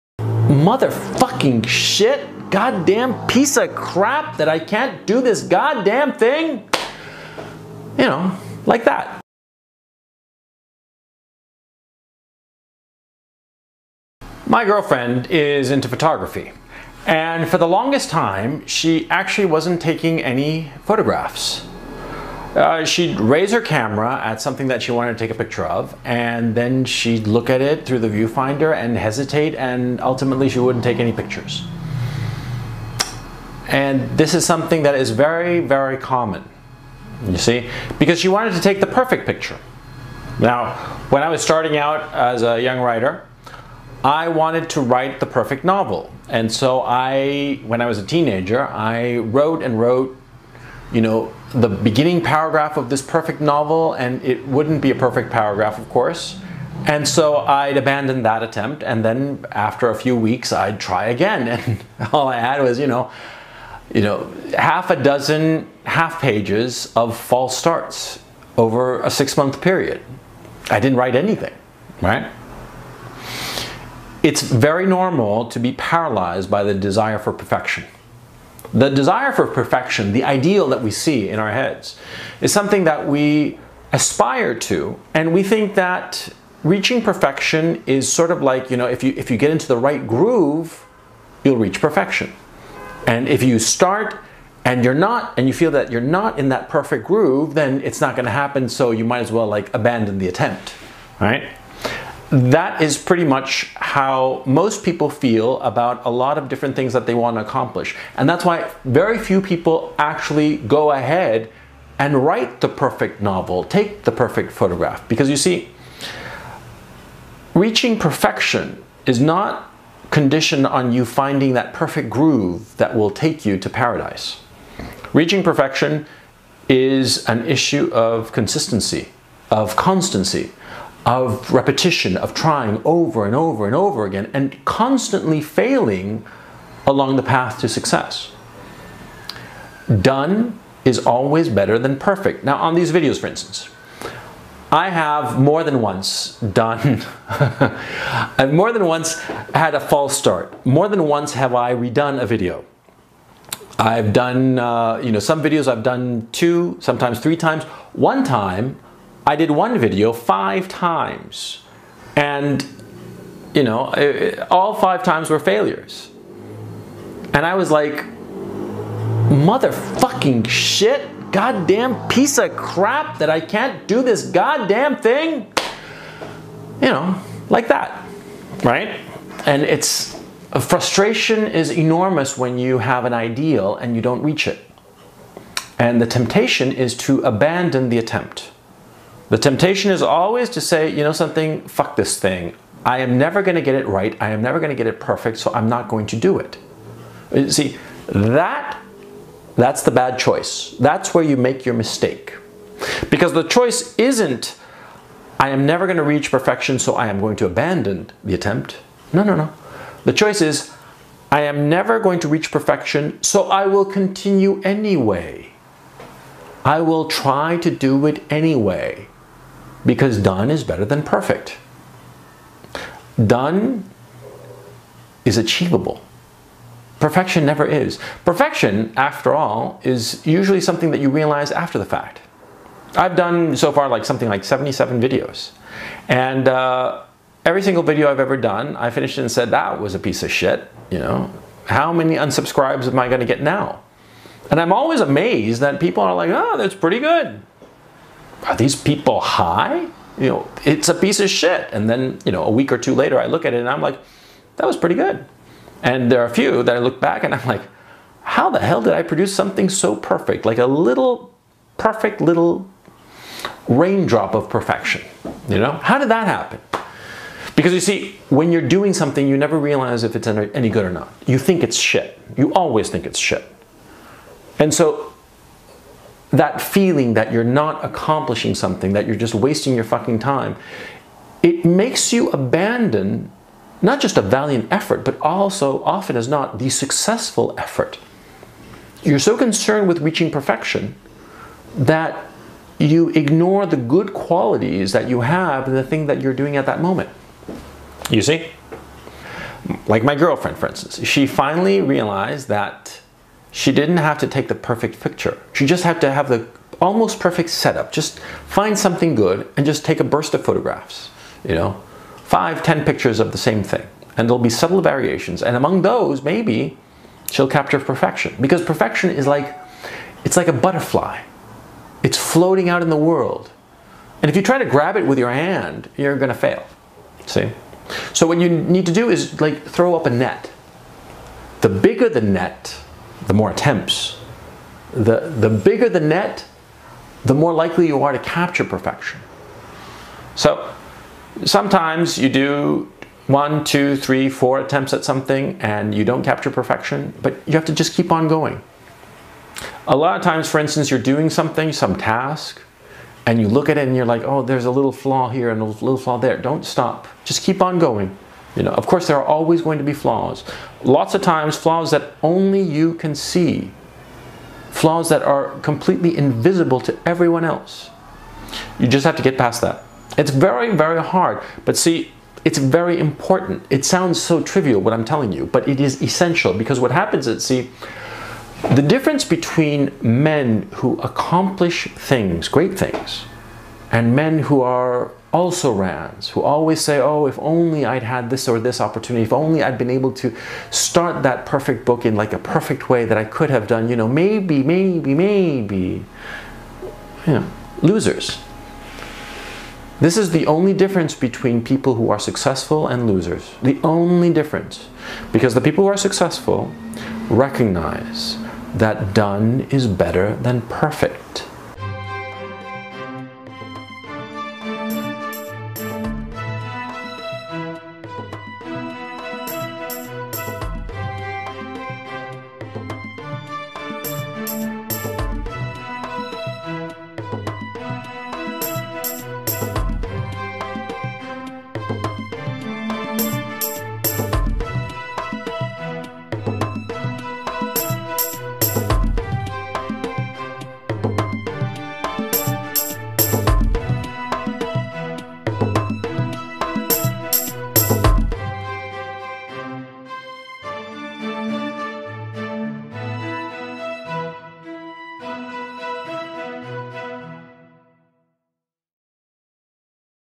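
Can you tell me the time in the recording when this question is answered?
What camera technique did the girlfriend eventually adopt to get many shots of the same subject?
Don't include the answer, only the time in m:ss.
5:10.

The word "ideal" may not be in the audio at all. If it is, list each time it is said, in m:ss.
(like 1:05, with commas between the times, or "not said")
1:20, 3:03.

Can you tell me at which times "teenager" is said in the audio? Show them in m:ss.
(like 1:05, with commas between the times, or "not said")
0:48.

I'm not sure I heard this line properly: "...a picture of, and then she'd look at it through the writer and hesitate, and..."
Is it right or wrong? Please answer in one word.
wrong.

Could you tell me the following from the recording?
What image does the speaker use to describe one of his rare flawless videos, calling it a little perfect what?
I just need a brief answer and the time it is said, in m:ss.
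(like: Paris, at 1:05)
Raindrop, at 4:23.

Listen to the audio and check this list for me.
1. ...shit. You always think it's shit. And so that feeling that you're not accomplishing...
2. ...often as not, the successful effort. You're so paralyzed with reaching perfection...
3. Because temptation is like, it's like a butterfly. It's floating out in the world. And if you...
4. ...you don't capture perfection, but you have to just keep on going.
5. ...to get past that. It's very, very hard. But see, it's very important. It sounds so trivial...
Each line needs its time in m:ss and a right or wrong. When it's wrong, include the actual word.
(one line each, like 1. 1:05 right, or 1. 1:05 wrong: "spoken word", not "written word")
1. 4:31 right
2. 4:45 wrong: "concerned", not "paralyzed"
3. 5:18 wrong: "perfection", not "temptation"
4. 5:45 right
5. 6:09 right.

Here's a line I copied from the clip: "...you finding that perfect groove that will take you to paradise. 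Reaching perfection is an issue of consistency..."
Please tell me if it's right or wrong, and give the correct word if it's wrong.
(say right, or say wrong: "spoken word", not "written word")
right.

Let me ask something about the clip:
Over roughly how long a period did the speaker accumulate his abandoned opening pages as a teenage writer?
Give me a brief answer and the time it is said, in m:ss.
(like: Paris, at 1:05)
6 months, at 1:09.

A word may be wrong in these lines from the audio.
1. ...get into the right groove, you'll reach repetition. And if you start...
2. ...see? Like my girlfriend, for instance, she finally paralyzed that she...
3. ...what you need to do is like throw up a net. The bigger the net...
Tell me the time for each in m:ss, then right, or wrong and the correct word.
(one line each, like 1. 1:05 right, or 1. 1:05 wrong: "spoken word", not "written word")
1. 1:29 wrong: "perfection", not "repetition"
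2. 4:58 wrong: "realized", not "paralyzed"
3. 5:28 right.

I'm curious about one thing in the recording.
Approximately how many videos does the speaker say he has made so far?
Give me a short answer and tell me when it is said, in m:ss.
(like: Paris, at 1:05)
77, at 3:54.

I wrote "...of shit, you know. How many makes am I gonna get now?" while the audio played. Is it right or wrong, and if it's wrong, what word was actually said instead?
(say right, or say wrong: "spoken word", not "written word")
wrong: "unsubscribes", not "makes".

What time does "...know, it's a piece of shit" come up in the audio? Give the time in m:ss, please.
4:10.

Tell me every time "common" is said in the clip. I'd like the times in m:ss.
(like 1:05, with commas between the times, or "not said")
0:35.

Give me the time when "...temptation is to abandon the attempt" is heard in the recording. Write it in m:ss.
3:06.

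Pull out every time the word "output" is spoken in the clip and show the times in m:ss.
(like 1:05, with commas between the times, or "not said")
not said.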